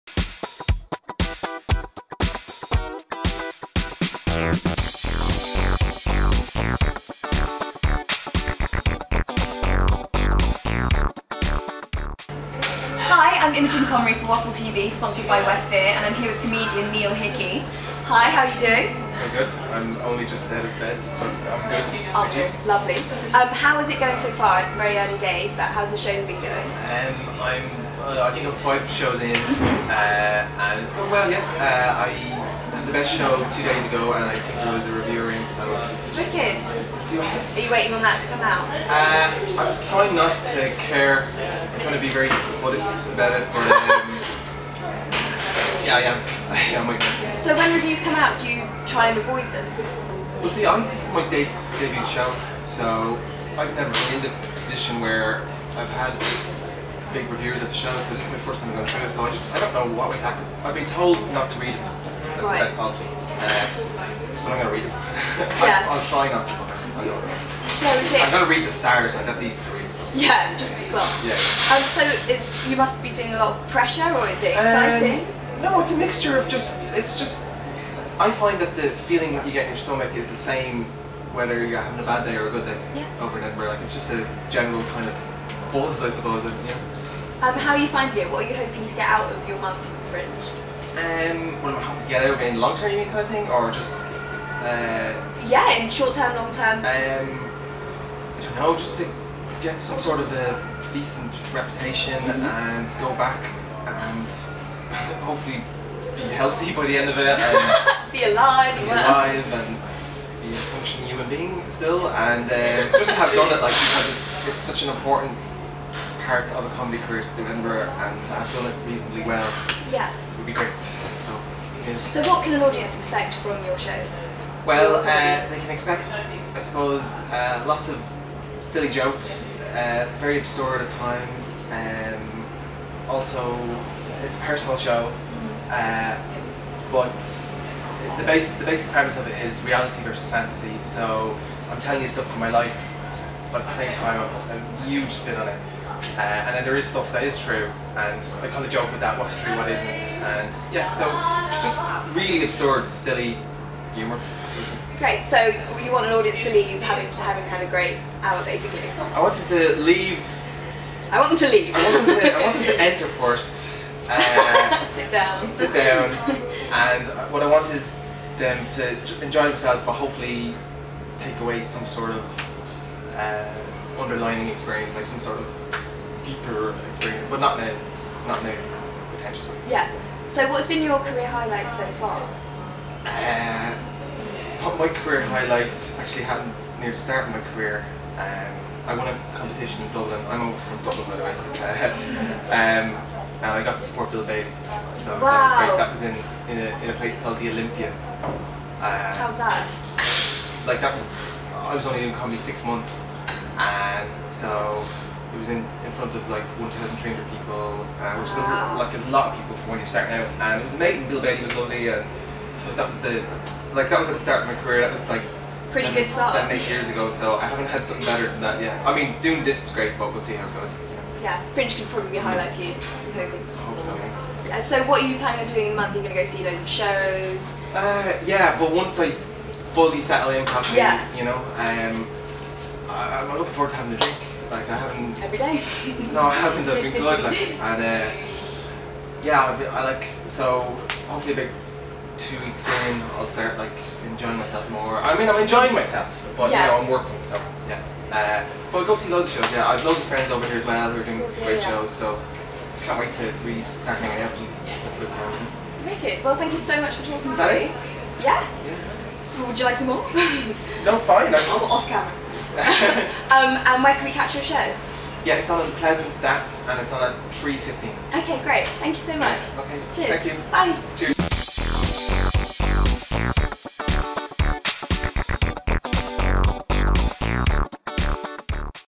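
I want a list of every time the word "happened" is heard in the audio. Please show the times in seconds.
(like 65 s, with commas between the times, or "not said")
186 s.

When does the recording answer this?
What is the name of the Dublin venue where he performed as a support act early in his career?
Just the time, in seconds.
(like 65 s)
197 s.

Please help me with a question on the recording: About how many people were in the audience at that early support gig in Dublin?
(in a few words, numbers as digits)
1,300.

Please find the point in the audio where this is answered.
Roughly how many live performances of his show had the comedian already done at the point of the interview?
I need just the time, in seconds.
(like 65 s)
28 s.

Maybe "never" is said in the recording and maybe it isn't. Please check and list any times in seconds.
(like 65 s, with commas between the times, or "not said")
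53 s.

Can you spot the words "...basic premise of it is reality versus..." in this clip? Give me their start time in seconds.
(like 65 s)
138 s.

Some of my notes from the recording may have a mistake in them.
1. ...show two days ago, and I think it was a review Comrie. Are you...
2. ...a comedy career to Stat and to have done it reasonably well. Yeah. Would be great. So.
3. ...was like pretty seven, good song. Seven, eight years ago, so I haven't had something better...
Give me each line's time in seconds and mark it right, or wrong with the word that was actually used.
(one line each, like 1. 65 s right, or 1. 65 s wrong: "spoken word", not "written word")
1. 33 s wrong: "Wicked", not "Comrie"
2. 116 s wrong: "Edinburgh", not "Stat"
3. 214 s right.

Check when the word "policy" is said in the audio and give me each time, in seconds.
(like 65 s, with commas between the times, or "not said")
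62 s.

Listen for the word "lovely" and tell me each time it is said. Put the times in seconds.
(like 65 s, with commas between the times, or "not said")
22 s, 211 s.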